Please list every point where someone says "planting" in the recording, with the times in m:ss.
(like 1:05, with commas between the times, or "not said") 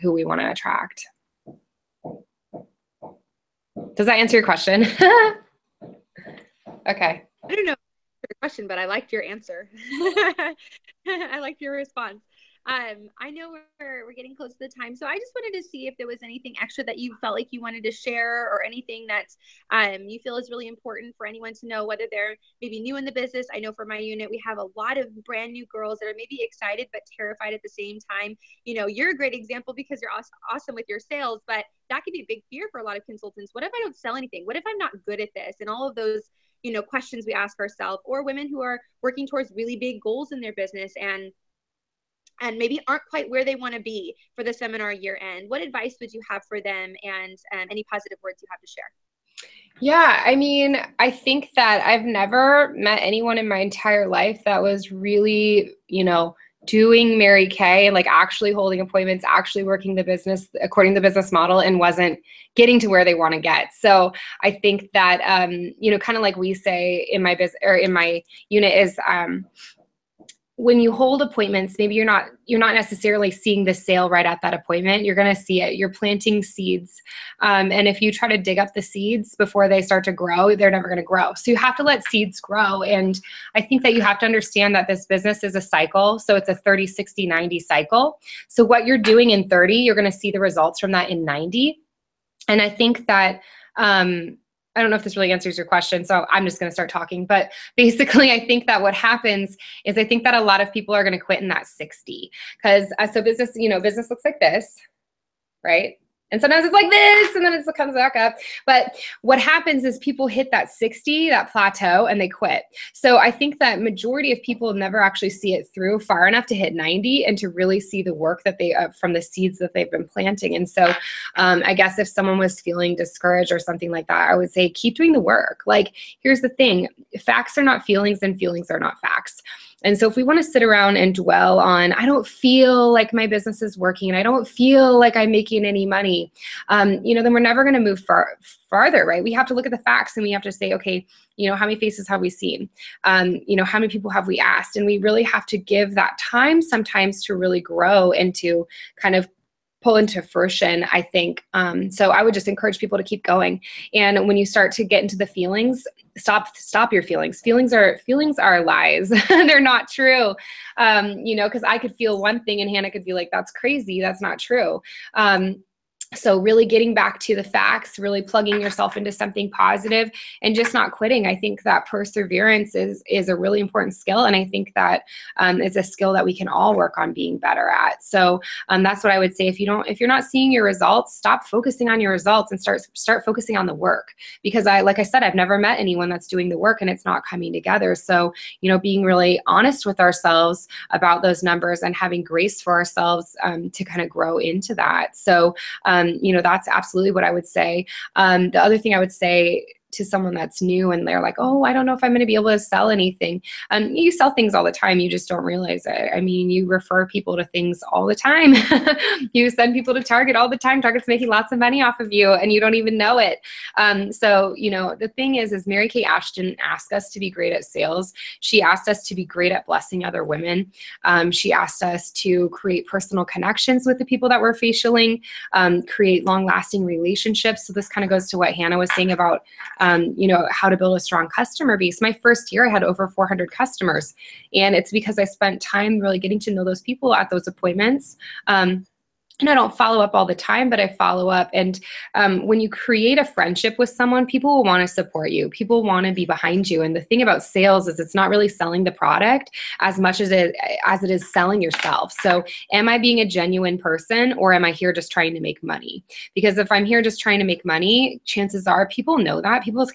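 1:15, 2:00.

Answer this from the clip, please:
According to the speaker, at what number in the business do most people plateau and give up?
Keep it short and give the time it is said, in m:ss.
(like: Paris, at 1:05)
60, at 1:41.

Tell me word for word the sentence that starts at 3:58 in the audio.
Um, and I don't follow up all the time, but I follow up.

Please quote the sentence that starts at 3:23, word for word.
Um, you sell things all the time.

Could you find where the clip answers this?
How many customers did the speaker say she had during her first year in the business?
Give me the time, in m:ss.
3:52.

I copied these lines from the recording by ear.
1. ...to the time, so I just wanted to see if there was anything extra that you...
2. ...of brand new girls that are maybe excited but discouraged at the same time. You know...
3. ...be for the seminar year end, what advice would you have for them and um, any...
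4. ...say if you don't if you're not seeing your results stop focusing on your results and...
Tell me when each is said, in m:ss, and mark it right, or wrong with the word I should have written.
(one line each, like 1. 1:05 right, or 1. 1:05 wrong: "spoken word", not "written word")
1. 0:14 right
2. 0:24 wrong: "terrified", not "discouraged"
3. 0:43 right
4. 2:59 right.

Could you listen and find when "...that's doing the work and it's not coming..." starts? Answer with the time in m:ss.
3:06.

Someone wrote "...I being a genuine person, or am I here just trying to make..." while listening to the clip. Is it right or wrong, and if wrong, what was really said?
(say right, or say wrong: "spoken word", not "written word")
right.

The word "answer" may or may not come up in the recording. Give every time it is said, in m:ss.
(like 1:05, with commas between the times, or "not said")
0:04, 0:09, 1:35.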